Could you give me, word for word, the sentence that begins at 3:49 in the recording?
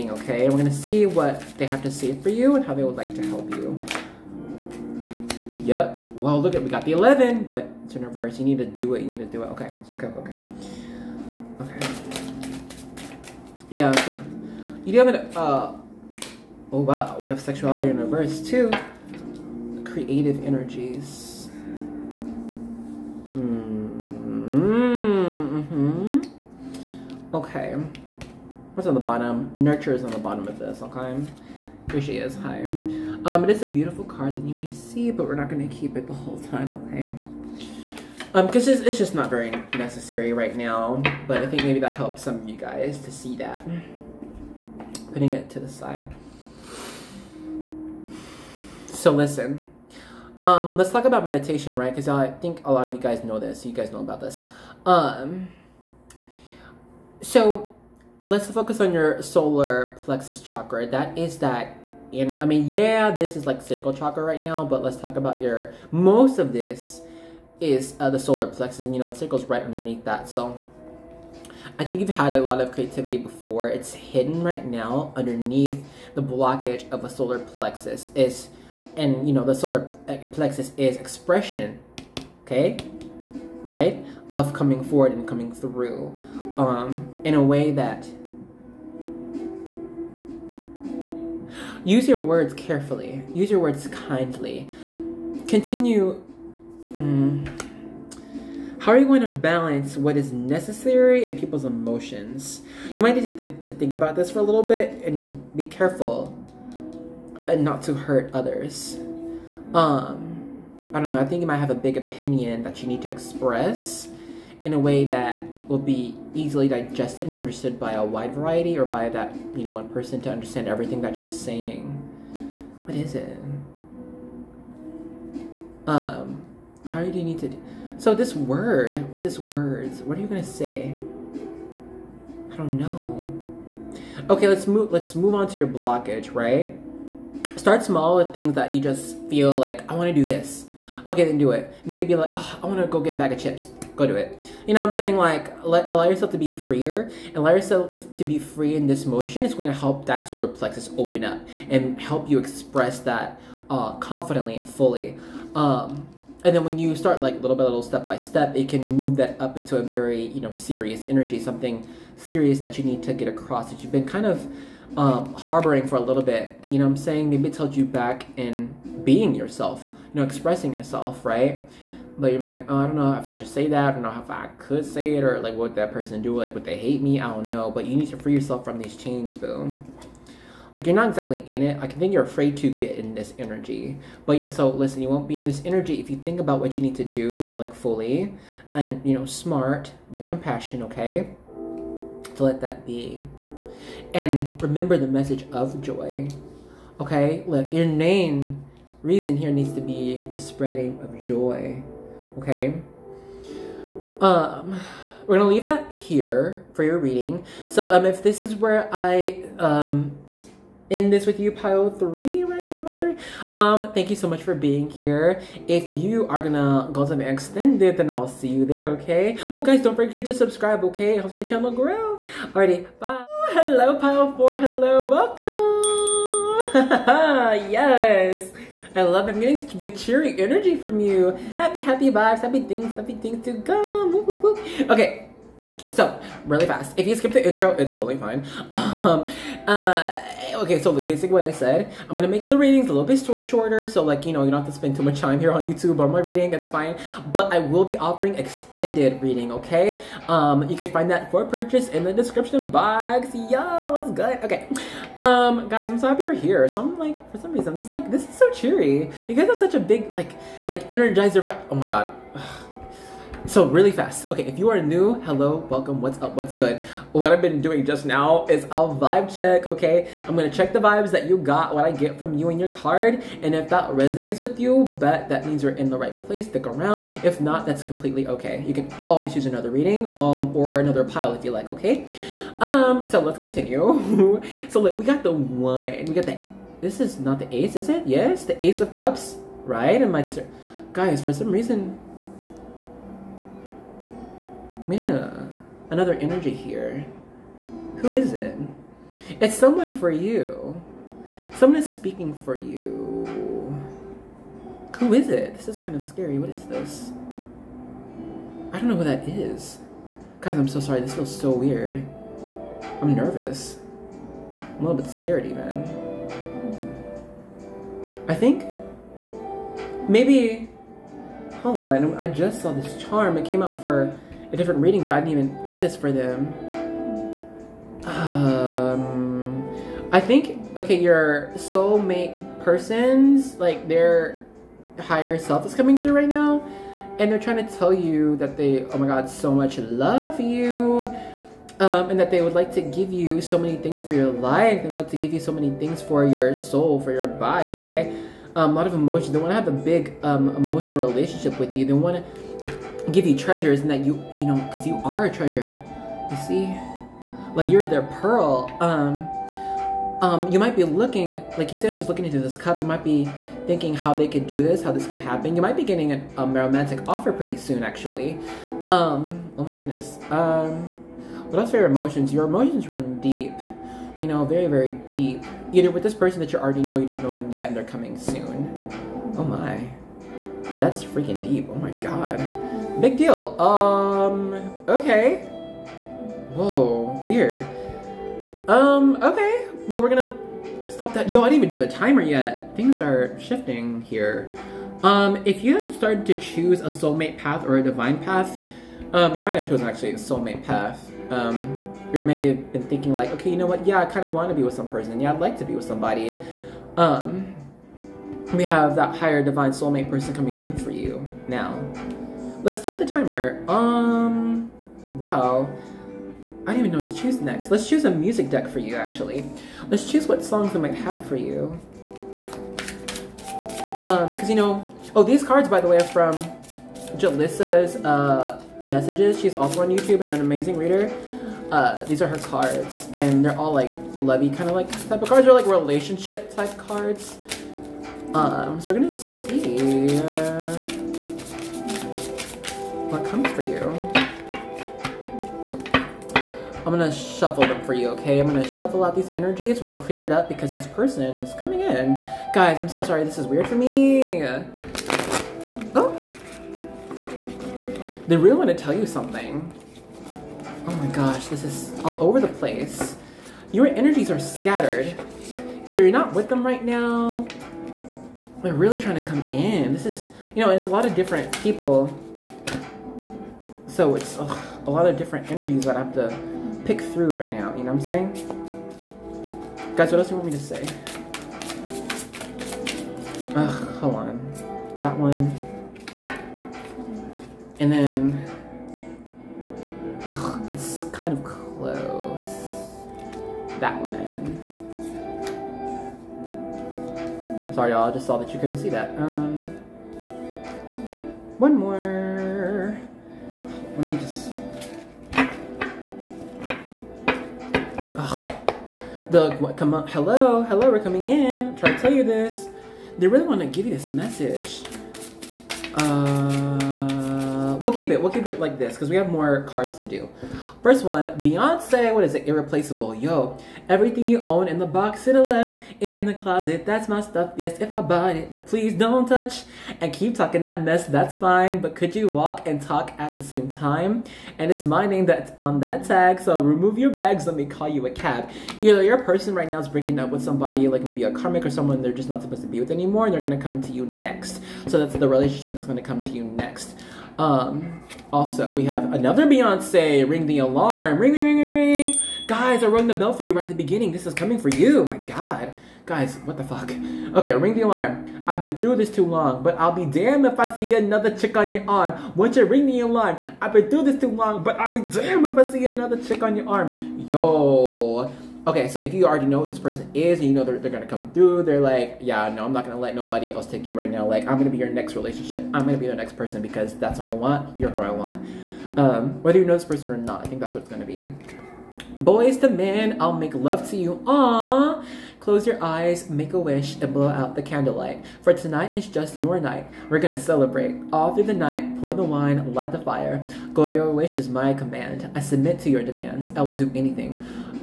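I'm getting such big cheery energy from you.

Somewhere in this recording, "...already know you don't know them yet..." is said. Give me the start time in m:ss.
6:16.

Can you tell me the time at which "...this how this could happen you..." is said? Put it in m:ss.
6:04.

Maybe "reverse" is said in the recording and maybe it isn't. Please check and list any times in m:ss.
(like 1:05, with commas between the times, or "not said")
0:08, 0:17.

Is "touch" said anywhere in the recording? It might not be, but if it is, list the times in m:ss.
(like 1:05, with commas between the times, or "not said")
8:49.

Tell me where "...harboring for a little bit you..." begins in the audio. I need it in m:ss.
2:45.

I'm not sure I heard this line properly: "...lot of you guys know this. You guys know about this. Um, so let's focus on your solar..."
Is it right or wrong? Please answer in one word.
right.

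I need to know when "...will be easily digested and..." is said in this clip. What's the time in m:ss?
1:55.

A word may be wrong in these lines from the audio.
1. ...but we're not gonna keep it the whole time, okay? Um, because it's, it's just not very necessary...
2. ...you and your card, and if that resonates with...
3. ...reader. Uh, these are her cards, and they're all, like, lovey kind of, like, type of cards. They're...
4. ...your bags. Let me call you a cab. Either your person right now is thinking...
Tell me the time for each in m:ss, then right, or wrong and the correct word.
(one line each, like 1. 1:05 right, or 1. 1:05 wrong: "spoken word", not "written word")
1. 0:35 right
2. 4:32 right
3. 7:10 right
4. 8:56 wrong: "breaking", not "thinking".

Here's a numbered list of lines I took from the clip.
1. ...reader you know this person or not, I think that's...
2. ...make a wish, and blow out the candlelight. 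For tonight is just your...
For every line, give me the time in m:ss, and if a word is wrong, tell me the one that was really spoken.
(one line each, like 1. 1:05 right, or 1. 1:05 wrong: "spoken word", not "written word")
1. 9:39 wrong: "whether", not "reader"
2. 9:46 right.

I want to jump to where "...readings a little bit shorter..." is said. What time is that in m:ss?
4:02.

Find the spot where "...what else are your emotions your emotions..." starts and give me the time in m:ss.
6:11.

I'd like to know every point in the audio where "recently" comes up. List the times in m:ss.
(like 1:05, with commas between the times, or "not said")
not said.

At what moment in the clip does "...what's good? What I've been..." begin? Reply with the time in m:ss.
4:26.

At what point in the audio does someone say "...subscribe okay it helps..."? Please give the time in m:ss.
3:40.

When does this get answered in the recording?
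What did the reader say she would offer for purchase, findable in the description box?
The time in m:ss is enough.
4:08.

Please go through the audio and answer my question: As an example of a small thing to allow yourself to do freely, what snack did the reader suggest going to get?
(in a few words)
A bag of chips.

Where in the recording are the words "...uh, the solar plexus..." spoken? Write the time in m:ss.
1:07.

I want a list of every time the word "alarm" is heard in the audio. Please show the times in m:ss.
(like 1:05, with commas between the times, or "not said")
9:10, 9:17, 9:23.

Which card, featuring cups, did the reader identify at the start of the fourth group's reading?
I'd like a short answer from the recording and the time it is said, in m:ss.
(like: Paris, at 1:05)
Ace of cups, at 4:48.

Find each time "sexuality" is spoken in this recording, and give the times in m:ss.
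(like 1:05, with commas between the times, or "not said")
0:17.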